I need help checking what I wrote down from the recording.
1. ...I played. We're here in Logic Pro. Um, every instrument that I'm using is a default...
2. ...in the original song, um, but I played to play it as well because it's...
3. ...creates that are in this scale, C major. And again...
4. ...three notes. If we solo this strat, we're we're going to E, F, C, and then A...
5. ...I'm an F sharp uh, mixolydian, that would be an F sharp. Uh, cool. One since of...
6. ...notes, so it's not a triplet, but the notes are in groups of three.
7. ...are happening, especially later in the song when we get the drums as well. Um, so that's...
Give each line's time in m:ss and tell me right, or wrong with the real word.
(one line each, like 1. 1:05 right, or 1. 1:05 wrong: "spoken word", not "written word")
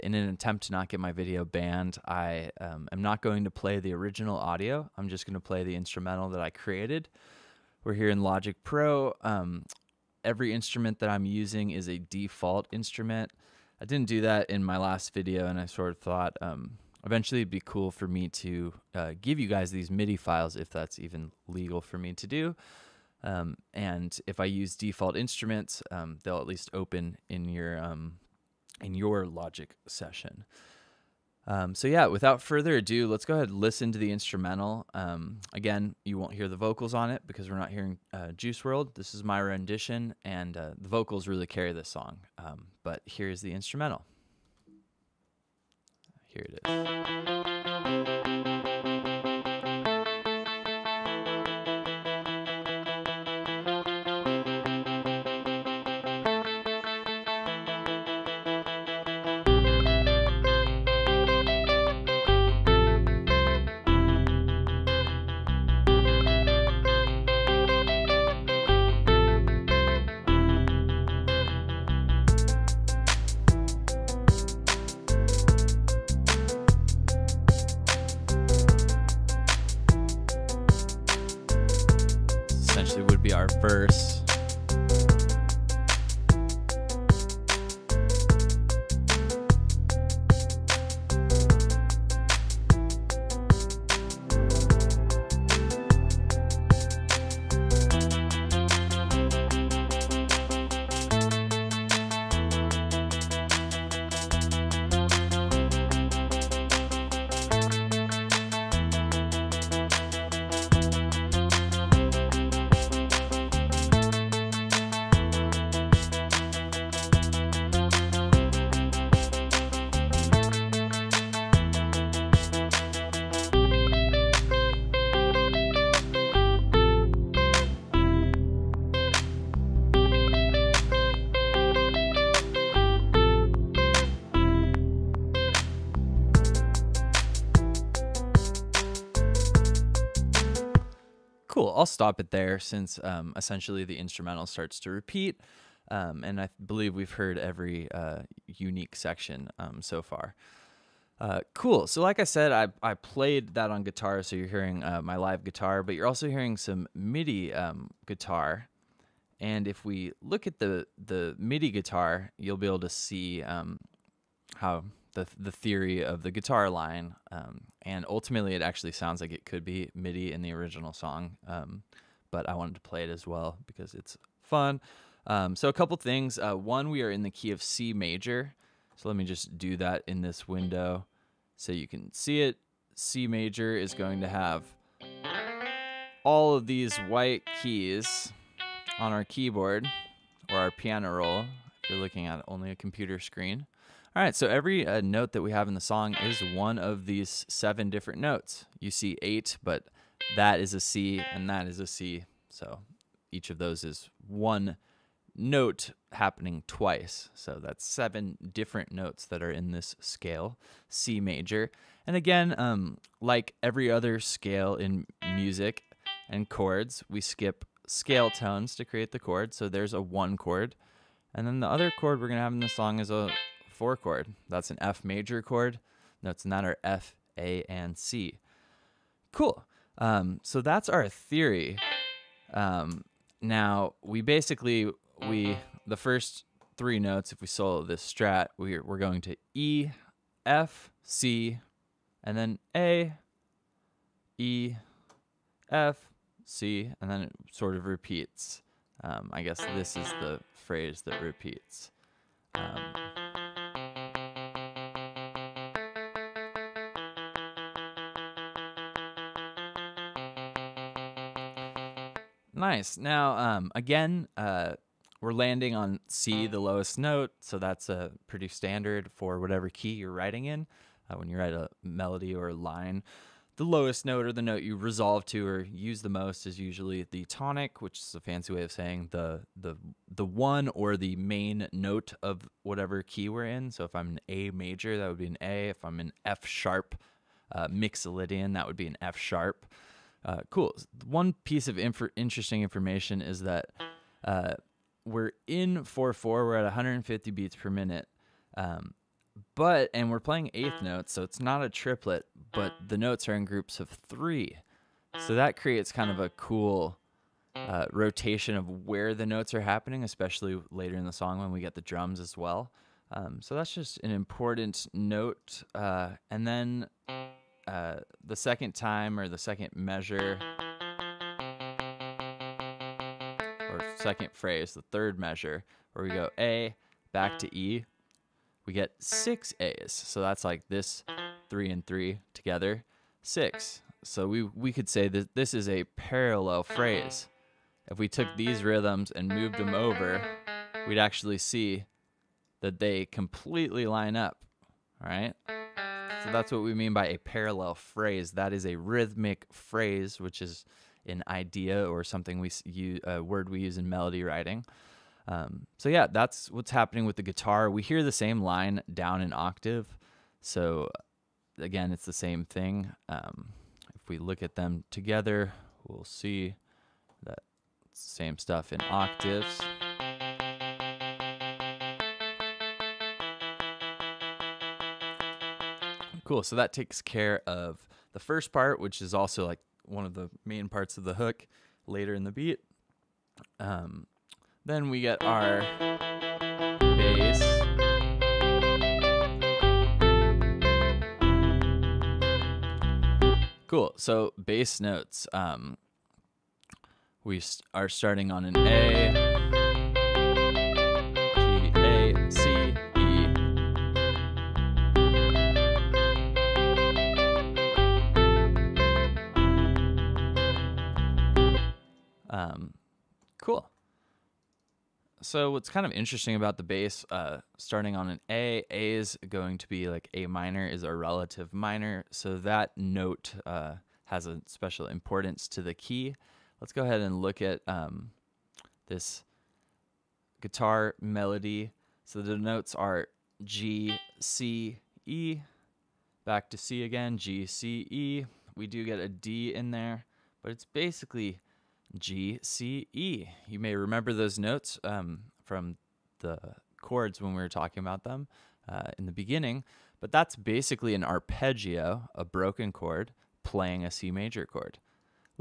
1. 0:06 wrong: "created", not "played"
2. 2:50 wrong: "wanted", not "played"
3. 3:28 wrong: "notes", not "creates"
4. 3:56 right
5. 4:45 wrong: "piece", not "since"
6. 5:00 right
7. 5:09 right.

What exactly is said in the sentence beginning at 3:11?
If you're looking at only a computer screen.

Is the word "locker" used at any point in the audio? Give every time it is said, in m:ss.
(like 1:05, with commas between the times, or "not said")
not said.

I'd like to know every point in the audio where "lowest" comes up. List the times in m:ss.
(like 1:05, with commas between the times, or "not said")
4:26, 4:33.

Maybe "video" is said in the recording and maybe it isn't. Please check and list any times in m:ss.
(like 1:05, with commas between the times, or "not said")
0:01, 0:15.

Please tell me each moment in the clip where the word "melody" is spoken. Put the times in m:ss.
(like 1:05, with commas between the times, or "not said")
4:31, 5:53, 7:11.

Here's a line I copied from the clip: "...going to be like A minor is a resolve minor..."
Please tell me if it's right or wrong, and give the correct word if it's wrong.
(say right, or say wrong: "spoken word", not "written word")
wrong: "relative", not "resolve".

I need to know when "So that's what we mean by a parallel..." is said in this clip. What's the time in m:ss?
5:46.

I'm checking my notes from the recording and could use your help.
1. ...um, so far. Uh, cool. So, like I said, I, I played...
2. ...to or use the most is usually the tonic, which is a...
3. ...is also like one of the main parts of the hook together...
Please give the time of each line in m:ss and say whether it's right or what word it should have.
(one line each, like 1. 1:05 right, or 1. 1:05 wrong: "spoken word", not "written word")
1. 2:29 right
2. 4:35 right
3. 6:19 wrong: "later", not "together".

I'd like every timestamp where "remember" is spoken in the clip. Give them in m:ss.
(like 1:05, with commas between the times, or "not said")
7:23.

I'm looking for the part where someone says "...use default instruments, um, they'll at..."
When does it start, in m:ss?
0:24.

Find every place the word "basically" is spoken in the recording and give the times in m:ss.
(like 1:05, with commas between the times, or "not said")
3:54, 7:20, 7:30.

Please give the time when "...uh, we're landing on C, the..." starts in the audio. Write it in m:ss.
4:24.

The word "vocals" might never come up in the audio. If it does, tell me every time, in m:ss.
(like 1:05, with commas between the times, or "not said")
0:36, 0:40.